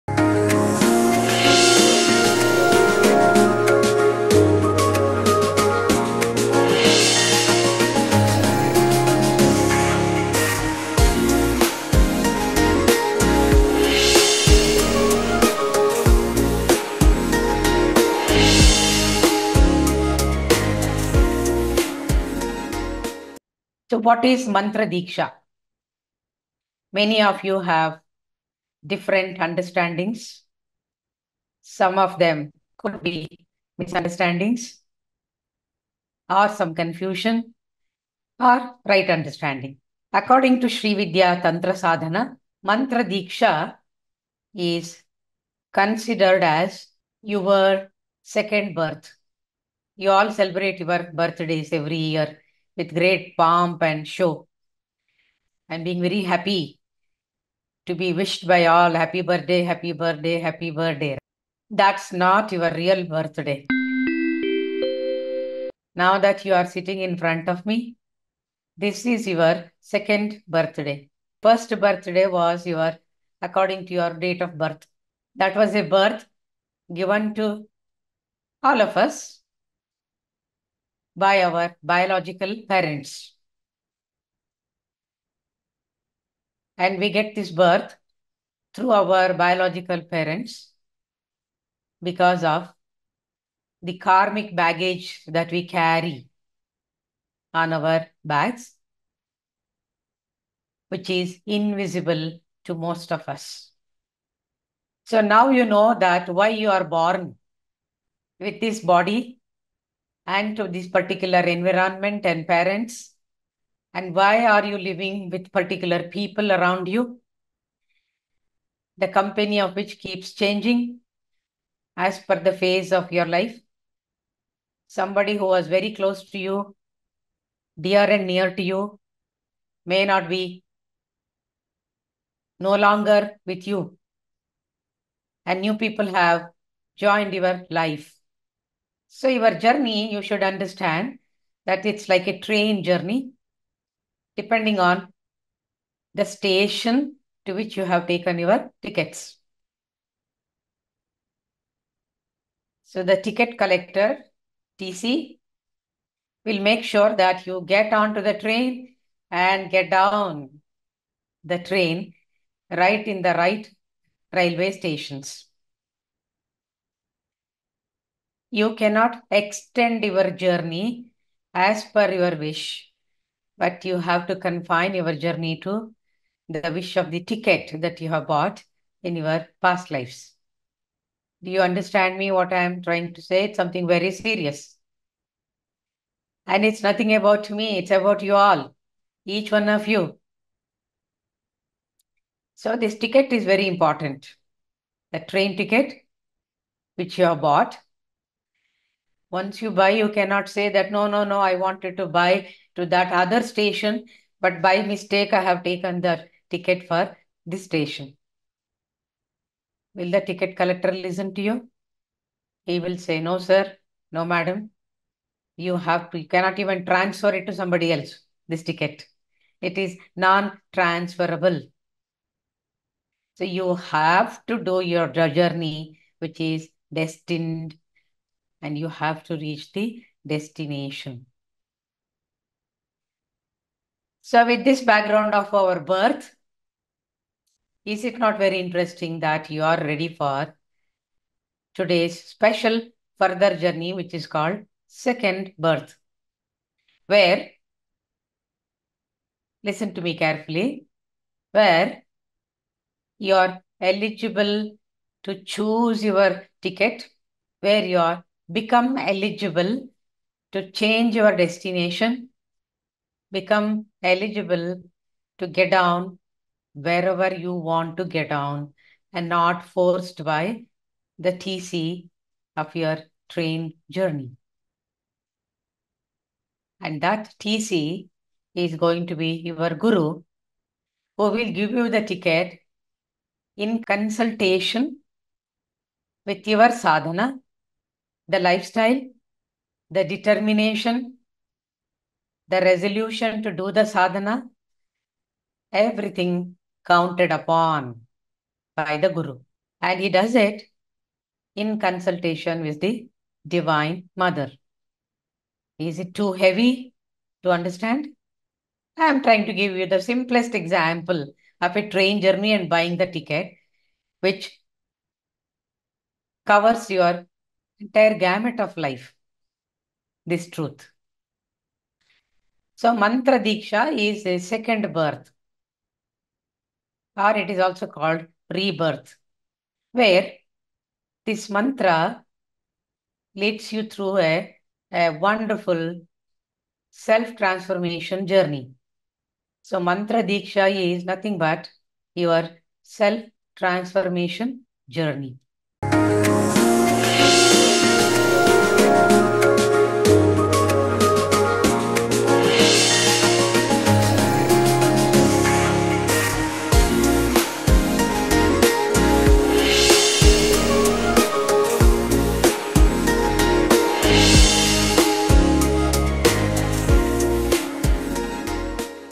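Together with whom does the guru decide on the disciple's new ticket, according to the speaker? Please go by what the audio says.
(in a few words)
The Divine Mother.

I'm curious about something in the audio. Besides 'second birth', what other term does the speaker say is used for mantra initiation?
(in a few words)
Rebirth.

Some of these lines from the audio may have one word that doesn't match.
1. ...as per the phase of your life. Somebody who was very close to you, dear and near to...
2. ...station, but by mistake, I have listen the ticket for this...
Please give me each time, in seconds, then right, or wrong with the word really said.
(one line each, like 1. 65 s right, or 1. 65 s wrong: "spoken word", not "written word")
1. 121 s right
2. 203 s wrong: "taken", not "listen".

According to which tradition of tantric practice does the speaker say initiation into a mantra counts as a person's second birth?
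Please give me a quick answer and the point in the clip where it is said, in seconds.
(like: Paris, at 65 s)
Sri Vidya Tantra Sadhana, at 40 s.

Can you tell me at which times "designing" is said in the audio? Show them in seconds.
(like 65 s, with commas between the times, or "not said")
not said.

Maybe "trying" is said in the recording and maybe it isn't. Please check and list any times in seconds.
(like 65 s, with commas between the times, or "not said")
182 s, 309 s.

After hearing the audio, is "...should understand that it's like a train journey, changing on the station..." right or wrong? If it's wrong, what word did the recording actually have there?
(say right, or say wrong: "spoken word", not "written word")
wrong: "depending", not "changing".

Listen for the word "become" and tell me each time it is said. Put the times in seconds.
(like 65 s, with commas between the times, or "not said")
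258 s, 263 s.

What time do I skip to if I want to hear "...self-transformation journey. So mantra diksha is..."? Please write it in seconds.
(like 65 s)
336 s.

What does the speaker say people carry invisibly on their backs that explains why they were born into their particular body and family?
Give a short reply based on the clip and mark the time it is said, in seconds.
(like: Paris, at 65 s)
Karmic baggage, at 94 s.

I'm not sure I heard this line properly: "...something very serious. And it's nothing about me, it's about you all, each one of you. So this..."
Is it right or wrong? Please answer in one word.
right.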